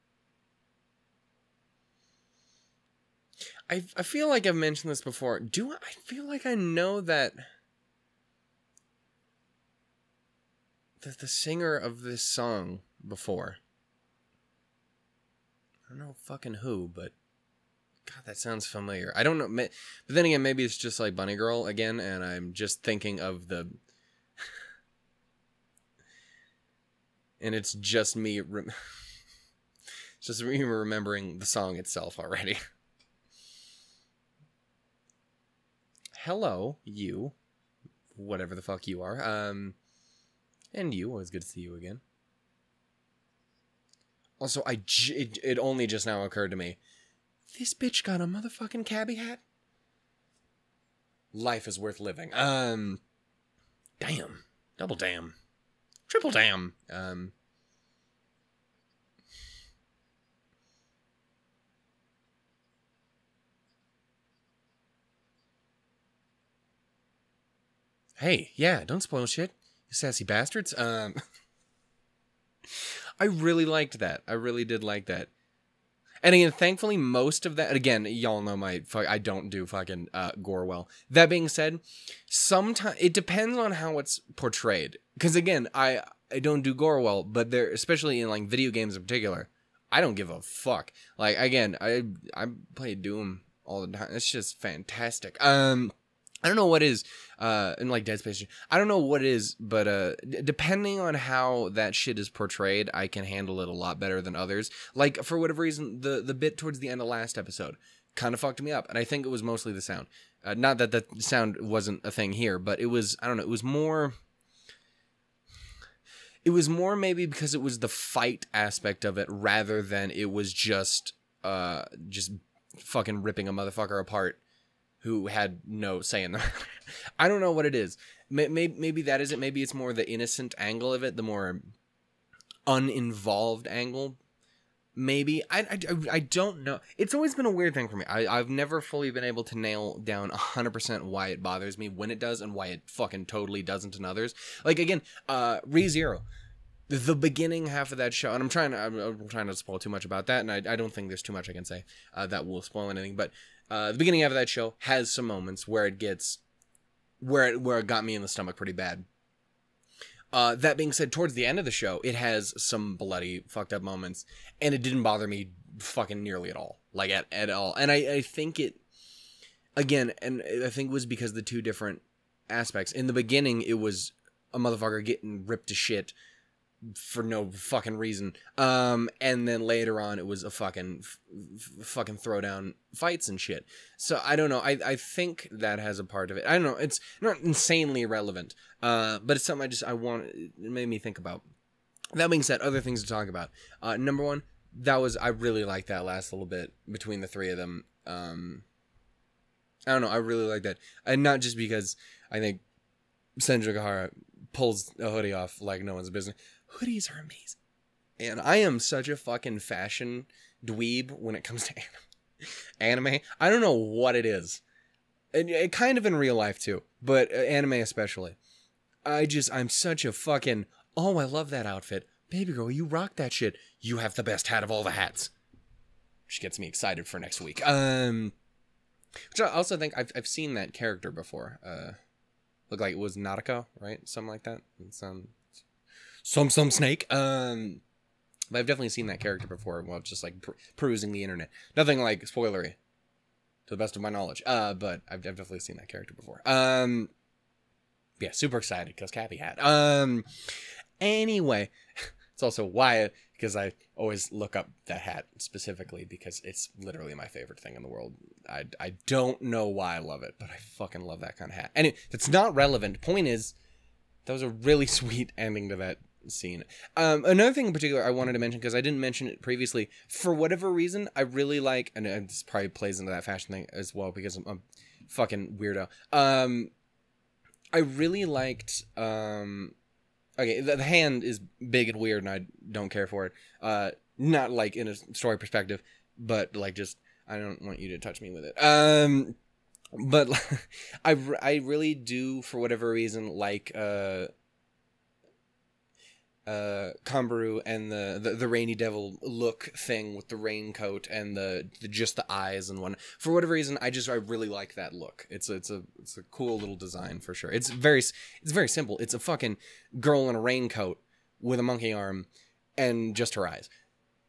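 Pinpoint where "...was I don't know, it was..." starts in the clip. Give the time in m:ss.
1:52.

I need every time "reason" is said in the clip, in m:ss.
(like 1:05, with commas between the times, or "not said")
1:45, 2:57, 4:30, 4:52, 5:03.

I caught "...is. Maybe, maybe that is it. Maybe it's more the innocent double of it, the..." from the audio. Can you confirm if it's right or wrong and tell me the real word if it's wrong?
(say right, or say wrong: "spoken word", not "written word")
wrong: "angle", not "double".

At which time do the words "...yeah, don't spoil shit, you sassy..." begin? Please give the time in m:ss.
1:08.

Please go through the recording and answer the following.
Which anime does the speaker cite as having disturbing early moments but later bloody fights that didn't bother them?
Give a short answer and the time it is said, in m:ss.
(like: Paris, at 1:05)
Re Zero, at 2:25.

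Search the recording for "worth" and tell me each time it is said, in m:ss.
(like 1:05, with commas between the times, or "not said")
0:51.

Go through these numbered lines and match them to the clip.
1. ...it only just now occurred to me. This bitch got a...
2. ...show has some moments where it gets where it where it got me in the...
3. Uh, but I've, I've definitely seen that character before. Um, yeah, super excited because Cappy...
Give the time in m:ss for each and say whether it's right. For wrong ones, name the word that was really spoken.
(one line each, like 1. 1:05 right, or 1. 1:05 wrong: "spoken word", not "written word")
1. 0:45 right
2. 2:34 right
3. 4:04 right.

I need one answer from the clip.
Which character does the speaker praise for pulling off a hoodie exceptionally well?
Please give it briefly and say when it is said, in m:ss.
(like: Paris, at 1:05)
Senjougahara, at 3:23.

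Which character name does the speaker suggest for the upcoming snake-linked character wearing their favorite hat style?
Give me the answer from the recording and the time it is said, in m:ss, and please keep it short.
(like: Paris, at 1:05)
Nadeko, at 3:53.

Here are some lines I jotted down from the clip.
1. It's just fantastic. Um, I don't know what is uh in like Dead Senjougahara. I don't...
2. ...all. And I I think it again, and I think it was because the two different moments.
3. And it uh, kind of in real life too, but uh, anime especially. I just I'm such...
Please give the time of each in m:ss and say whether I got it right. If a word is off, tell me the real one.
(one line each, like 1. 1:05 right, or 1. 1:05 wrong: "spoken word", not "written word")
1. 1:34 wrong: "Space", not "Senjougahara"
2. 2:47 wrong: "aspects", not "moments"
3. 3:35 right.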